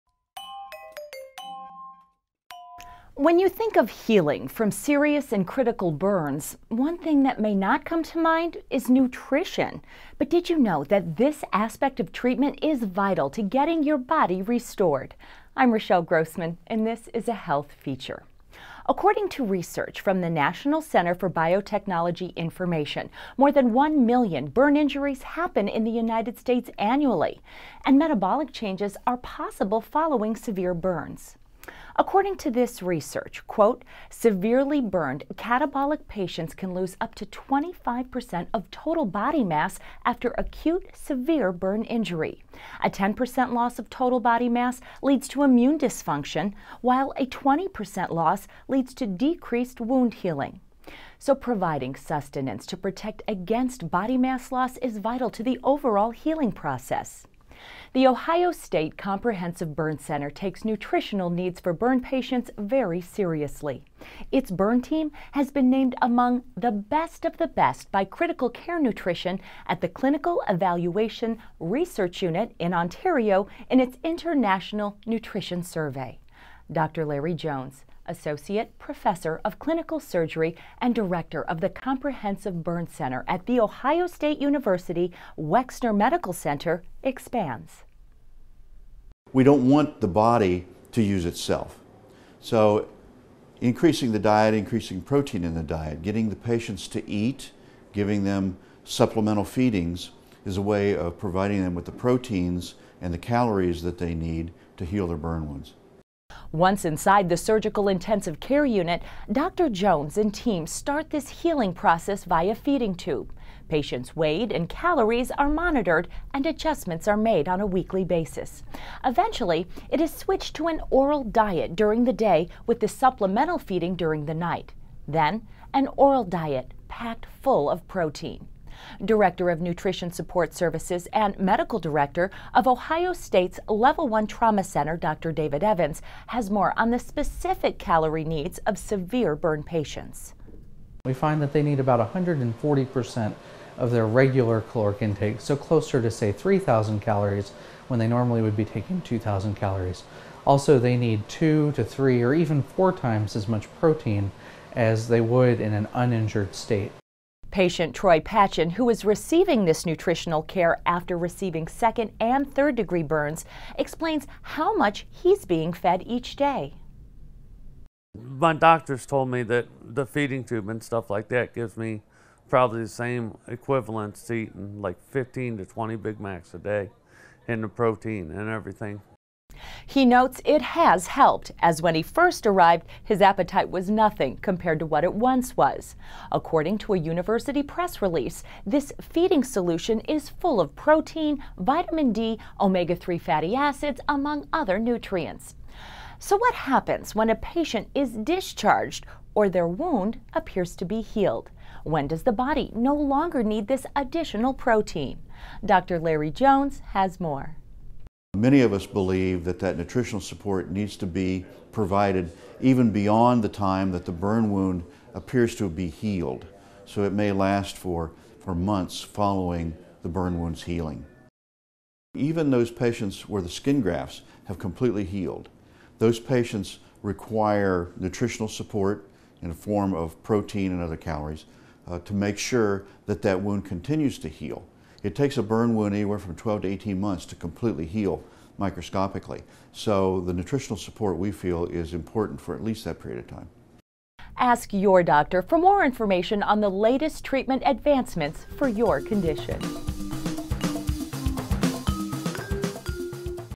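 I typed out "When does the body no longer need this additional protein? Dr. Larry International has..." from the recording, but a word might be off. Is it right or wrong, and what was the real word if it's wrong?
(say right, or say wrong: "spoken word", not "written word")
wrong: "Jones", not "International".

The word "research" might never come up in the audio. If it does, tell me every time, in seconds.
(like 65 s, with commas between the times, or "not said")
19 s, 32 s, 71 s.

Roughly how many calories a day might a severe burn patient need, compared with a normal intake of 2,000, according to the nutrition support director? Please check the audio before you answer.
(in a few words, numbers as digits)
3,000.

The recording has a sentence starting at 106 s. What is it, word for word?
Once inside the surgical intensive care unit, Dr.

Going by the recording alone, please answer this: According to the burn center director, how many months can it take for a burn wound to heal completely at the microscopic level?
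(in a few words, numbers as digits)
12 to 18.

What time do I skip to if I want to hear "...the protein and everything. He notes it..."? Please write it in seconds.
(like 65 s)
177 s.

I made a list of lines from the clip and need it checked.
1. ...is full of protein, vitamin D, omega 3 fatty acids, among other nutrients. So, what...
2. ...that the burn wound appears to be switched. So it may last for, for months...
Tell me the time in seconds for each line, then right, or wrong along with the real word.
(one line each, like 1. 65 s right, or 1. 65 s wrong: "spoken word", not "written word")
1. 190 s right
2. 213 s wrong: "healed", not "switched".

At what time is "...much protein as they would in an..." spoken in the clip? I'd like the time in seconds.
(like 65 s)
153 s.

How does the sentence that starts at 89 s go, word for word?
We don't want the body to use itself.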